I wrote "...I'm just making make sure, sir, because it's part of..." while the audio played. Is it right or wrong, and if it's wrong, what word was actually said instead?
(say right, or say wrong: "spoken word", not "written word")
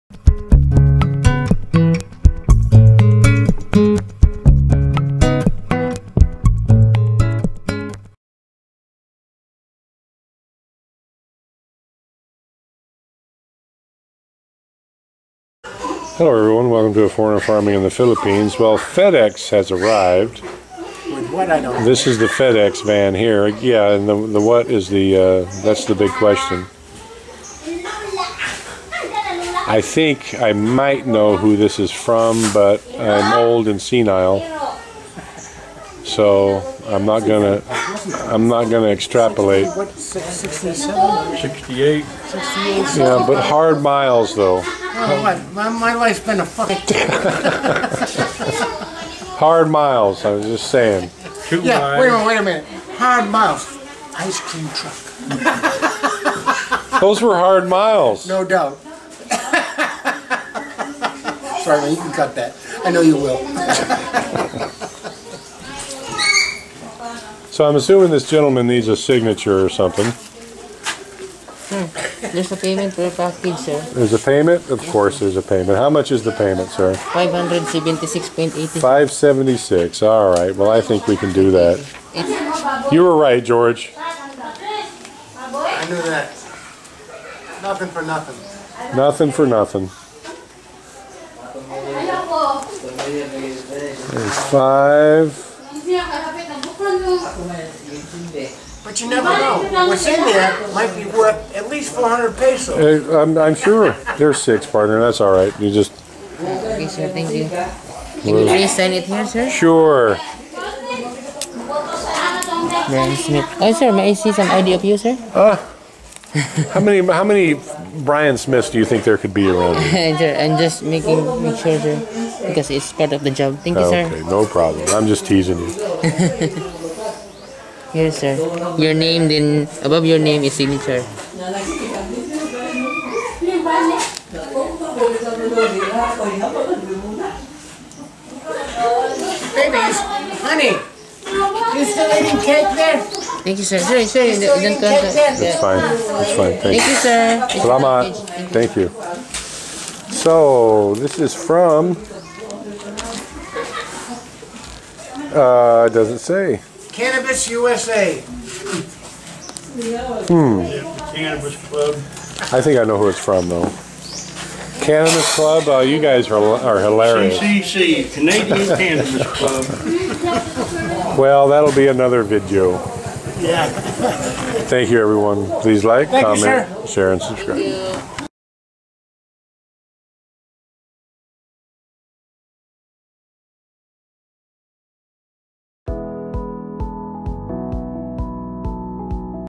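right.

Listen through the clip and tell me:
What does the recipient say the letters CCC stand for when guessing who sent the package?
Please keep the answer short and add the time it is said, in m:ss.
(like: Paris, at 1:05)
Canadian Cannabis Club, at 2:48.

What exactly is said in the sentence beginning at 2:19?
Babies, honey, you still eating cake there?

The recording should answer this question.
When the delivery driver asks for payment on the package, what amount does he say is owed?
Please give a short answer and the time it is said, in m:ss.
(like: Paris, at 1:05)
576.80, at 1:16.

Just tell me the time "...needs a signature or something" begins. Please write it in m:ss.
1:08.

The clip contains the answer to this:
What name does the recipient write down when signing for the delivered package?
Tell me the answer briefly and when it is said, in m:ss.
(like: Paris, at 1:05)
Brian Smith, at 1:52.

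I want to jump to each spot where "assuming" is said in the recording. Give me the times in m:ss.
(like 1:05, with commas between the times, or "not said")
1:07.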